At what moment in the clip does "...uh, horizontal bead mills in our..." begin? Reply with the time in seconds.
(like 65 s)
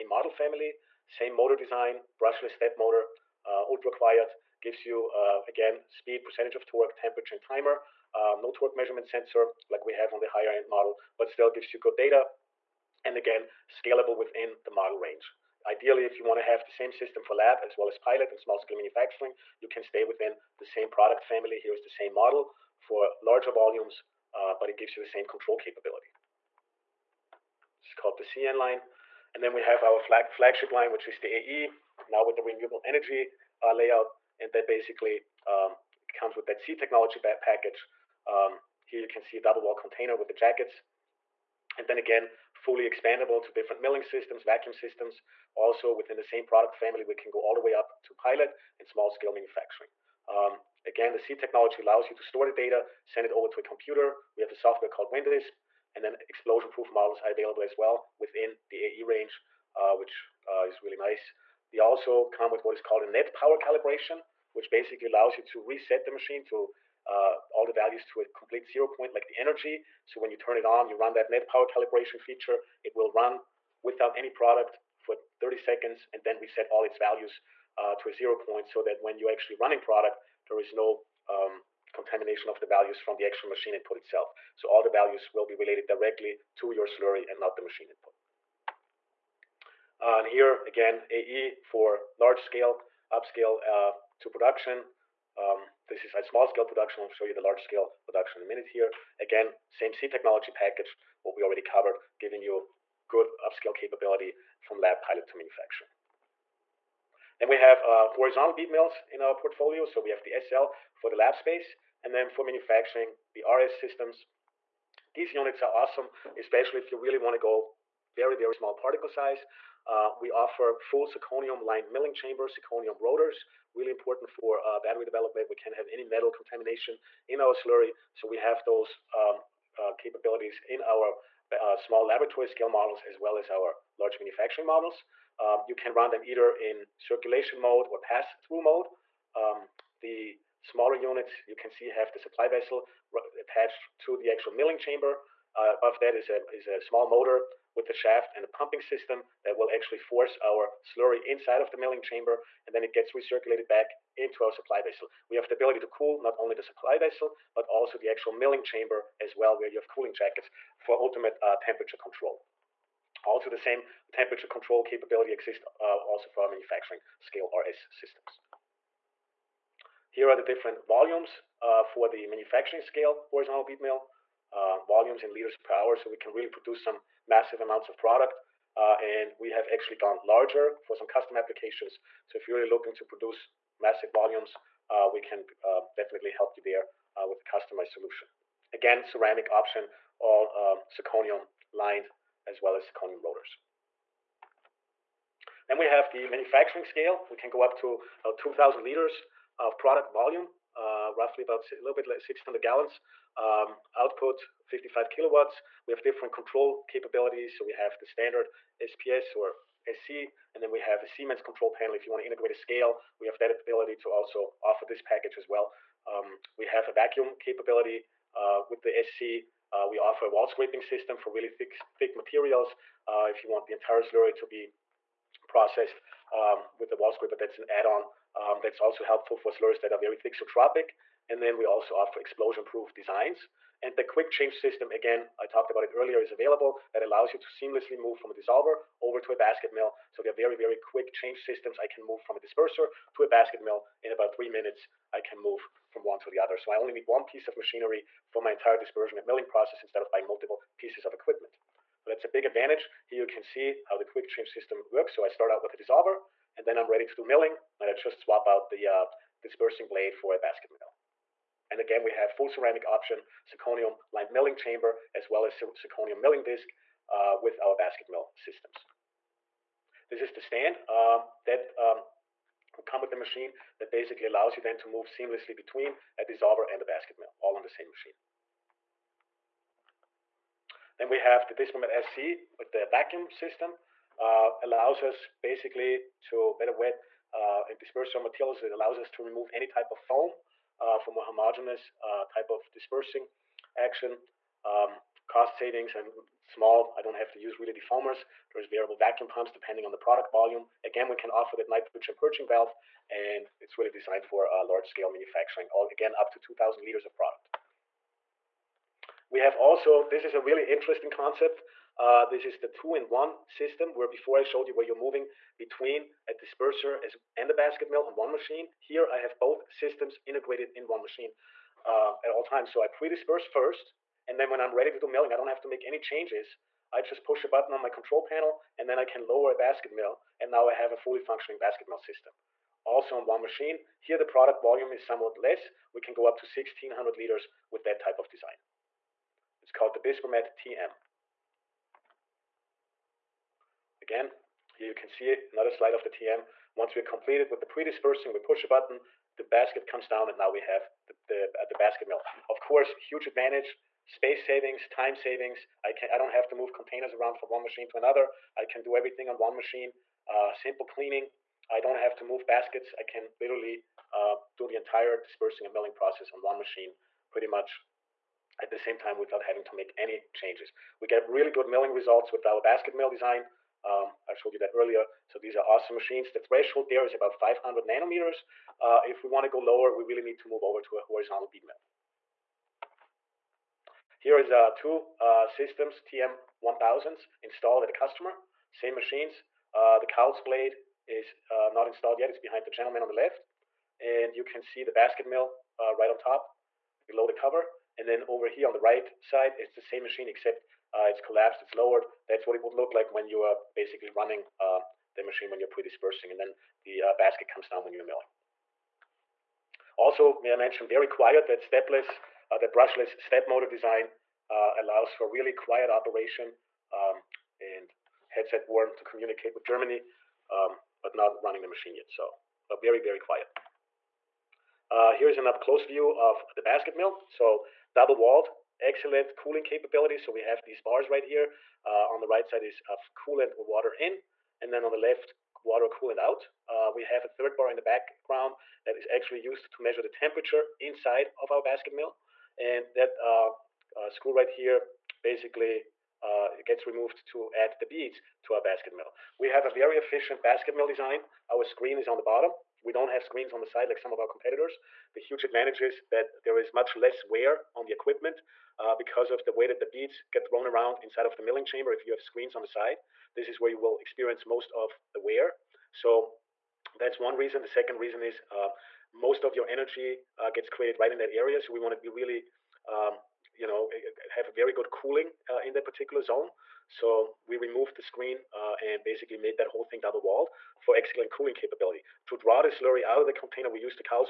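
107 s.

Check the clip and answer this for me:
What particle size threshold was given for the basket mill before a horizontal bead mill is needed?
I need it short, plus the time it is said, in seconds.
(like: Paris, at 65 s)
500 nanometers, at 377 s.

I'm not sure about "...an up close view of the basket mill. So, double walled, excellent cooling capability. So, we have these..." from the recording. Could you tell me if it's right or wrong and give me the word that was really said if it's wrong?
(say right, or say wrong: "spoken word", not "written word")
right.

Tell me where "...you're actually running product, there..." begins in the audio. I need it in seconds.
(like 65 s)
79 s.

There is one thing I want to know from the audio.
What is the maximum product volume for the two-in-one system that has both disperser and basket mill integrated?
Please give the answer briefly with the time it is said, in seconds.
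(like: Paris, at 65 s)
1600 liters, at 336 s.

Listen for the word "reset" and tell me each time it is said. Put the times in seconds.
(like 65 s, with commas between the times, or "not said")
65 s, 76 s.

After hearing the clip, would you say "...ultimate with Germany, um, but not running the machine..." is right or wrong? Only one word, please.
wrong.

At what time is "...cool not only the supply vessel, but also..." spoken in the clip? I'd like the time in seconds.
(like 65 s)
155 s.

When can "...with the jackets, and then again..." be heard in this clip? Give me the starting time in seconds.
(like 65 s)
40 s.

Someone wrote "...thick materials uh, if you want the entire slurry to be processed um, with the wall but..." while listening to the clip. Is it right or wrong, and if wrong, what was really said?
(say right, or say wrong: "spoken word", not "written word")
right.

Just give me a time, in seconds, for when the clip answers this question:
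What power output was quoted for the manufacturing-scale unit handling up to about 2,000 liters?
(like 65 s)
204 s.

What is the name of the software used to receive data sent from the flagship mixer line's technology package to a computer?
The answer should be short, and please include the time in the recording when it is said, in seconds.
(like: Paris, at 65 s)
WinDisp, at 55 s.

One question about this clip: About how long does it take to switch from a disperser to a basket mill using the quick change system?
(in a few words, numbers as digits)
3 minutes.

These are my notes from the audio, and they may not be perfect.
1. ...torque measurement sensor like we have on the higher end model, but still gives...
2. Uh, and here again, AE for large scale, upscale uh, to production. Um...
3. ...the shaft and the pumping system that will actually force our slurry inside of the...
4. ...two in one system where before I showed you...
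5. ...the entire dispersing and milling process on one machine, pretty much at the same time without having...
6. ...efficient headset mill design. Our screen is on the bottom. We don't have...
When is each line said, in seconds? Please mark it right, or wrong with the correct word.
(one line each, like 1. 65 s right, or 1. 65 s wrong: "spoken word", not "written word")
1. 8 s right
2. 90 s right
3. 147 s right
4. 312 s right
5. 364 s right
6. 449 s wrong: "basket", not "headset".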